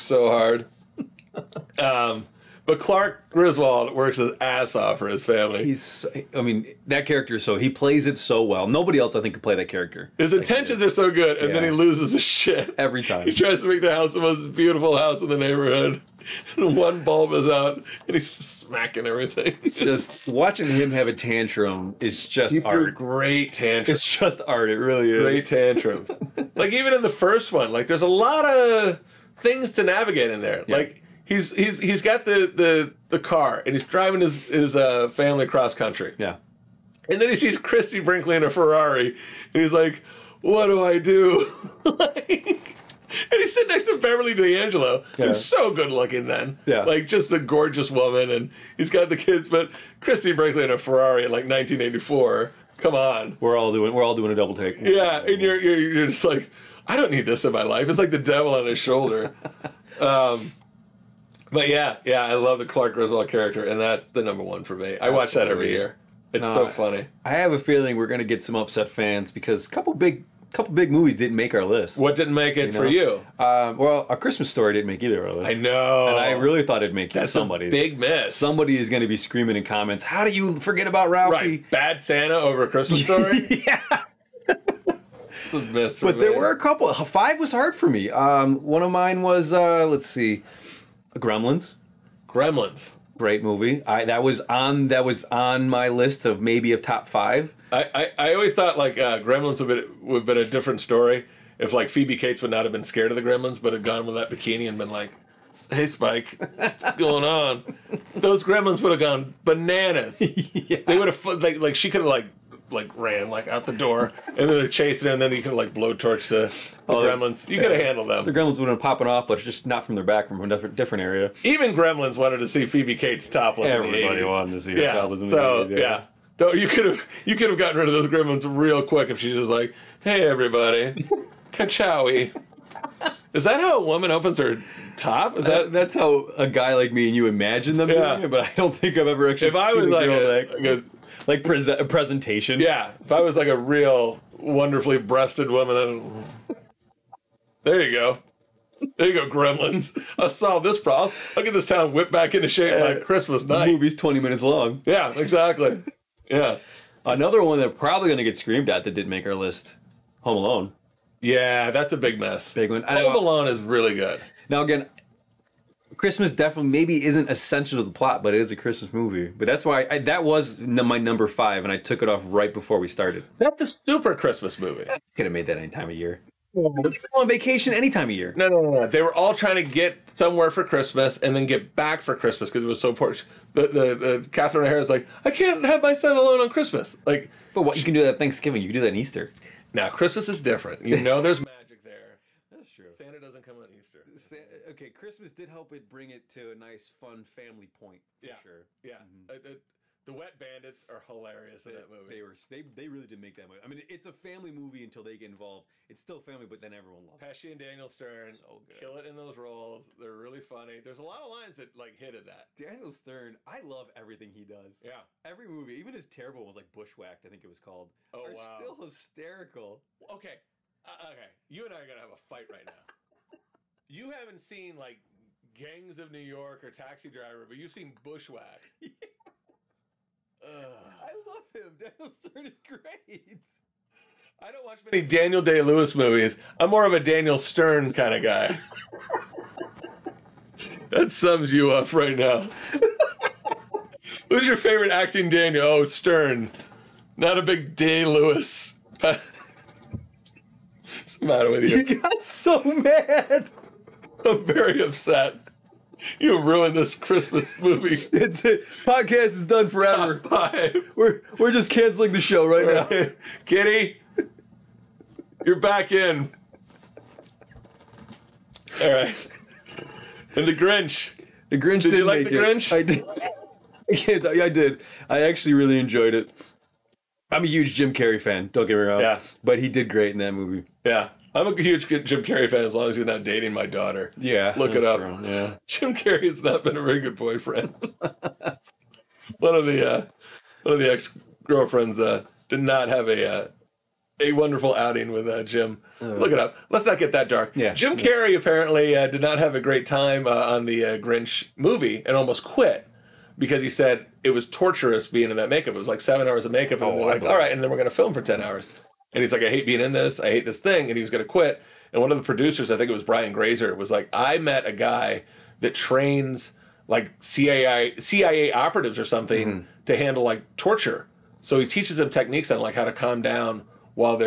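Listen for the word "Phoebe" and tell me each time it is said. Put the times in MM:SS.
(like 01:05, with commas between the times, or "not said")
01:41, 02:02.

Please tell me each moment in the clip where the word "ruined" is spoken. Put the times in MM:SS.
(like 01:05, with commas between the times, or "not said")
04:16.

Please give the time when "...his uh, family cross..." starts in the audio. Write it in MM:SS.
00:34.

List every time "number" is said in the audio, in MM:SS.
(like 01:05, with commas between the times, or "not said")
01:04, 02:50.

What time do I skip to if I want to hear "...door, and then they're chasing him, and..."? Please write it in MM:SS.
01:53.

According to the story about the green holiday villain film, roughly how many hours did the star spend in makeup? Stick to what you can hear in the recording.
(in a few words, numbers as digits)
7.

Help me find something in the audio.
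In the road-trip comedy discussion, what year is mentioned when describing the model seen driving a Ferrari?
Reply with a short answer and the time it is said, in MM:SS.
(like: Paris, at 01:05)
1984, at 00:51.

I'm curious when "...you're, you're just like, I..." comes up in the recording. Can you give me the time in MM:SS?
00:55.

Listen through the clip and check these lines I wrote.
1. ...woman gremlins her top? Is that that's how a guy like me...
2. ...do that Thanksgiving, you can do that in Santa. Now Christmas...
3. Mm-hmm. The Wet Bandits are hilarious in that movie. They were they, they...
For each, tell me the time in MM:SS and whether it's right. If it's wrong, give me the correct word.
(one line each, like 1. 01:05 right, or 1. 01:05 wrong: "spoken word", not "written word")
1. 02:13 wrong: "opens", not "gremlins"
2. 03:07 wrong: "Easter", not "Santa"
3. 03:19 right.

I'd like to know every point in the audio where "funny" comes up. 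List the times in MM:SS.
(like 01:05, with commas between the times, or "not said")
01:06, 03:30.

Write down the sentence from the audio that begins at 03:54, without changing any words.
I don't watch many Daniel Day Lewis movies.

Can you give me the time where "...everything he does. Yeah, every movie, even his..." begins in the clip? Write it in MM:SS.
03:33.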